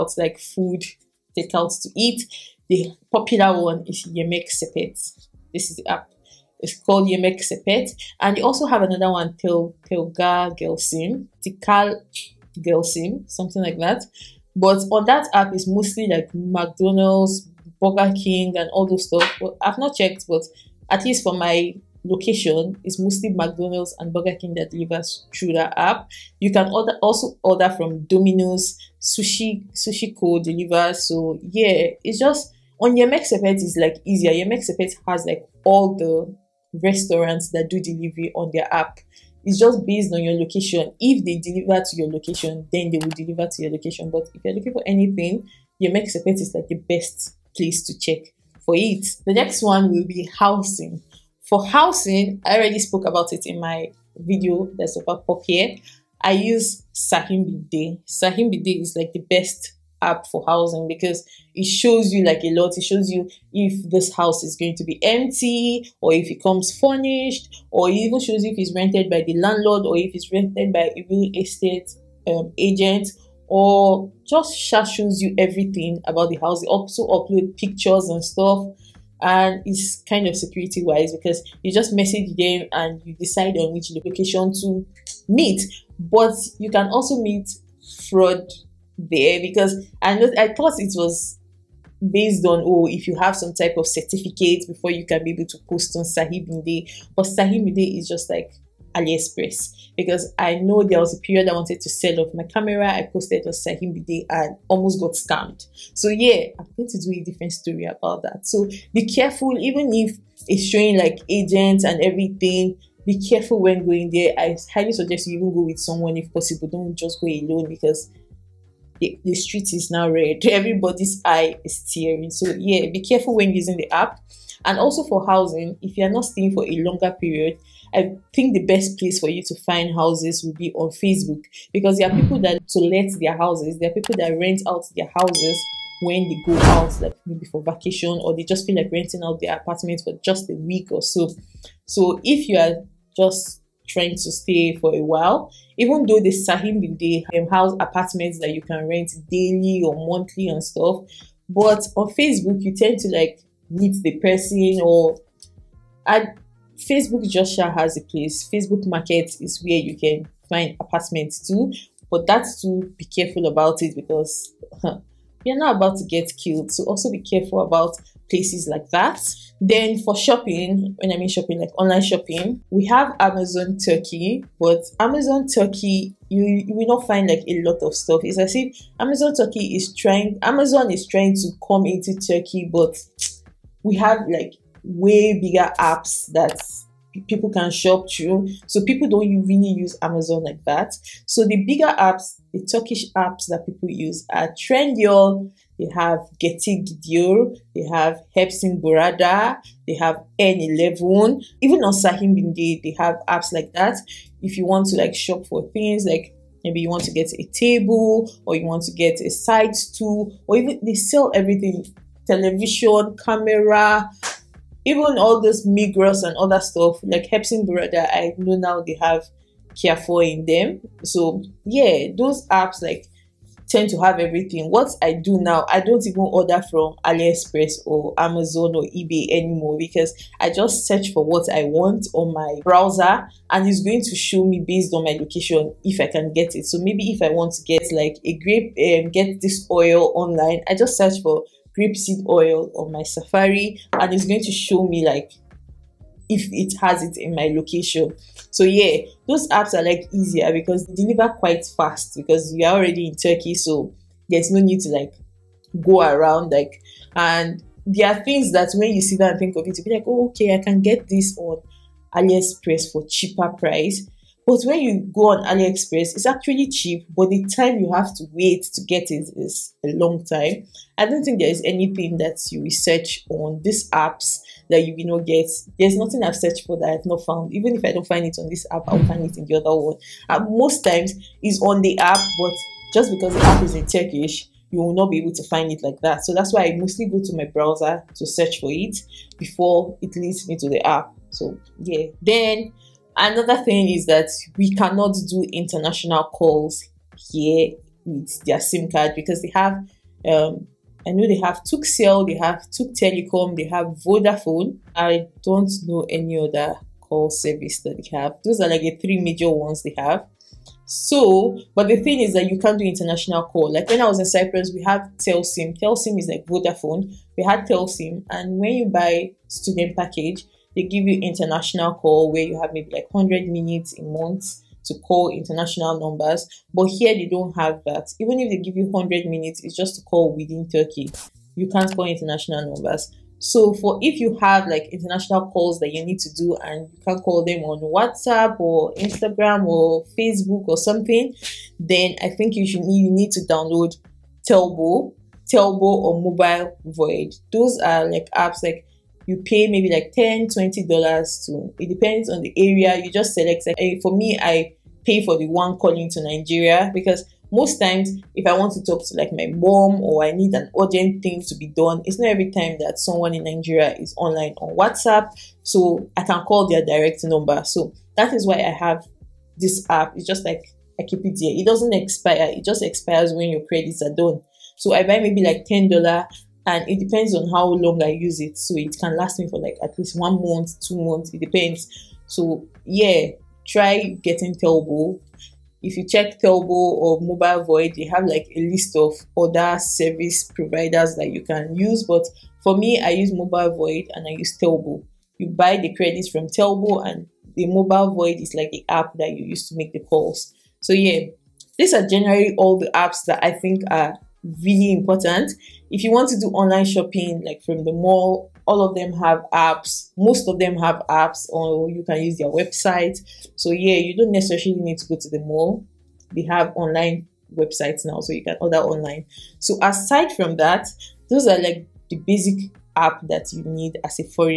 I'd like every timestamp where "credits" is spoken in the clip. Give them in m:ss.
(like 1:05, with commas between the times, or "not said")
6:13, 6:35.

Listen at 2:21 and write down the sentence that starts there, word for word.
So if you are just trying to stay for a while.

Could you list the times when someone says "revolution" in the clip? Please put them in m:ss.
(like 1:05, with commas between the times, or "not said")
not said.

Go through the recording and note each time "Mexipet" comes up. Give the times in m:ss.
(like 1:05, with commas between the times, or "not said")
0:45.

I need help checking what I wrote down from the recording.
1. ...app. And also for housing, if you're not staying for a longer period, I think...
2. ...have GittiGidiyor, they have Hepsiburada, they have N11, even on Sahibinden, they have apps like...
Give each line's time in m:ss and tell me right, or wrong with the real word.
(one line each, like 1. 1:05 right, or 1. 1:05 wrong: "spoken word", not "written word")
1. 2:03 right
2. 3:15 right.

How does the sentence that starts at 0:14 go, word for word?
But on that app, it's mostly like McDonald's, Burger King, and all those stuff.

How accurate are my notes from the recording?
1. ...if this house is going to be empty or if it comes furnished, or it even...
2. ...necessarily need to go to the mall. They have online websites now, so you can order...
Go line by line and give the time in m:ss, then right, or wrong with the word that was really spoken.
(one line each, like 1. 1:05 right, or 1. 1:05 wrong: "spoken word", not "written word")
1. 1:03 right
2. 6:54 right.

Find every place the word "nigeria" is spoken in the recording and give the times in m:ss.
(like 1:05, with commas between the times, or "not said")
5:56, 6:03.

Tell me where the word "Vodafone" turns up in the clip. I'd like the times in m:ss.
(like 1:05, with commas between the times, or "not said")
5:04, 5:16.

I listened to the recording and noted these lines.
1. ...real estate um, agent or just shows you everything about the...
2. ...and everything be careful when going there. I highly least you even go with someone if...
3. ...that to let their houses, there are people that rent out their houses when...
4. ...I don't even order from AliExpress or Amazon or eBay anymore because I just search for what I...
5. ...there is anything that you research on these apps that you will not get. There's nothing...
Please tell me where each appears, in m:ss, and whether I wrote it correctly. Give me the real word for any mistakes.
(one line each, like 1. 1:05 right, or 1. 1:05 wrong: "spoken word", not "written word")
1. 1:11 right
2. 1:51 wrong: "suggest", not "least"
3. 2:12 right
4. 3:45 right
5. 4:31 right.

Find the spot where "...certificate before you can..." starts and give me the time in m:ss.
1:33.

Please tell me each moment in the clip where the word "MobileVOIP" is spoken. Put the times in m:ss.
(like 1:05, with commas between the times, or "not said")
5:46, 6:27, 6:33, 6:37.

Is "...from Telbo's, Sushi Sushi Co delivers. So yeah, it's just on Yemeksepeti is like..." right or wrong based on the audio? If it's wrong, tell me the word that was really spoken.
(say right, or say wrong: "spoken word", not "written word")
wrong: "Domino", not "Telbo".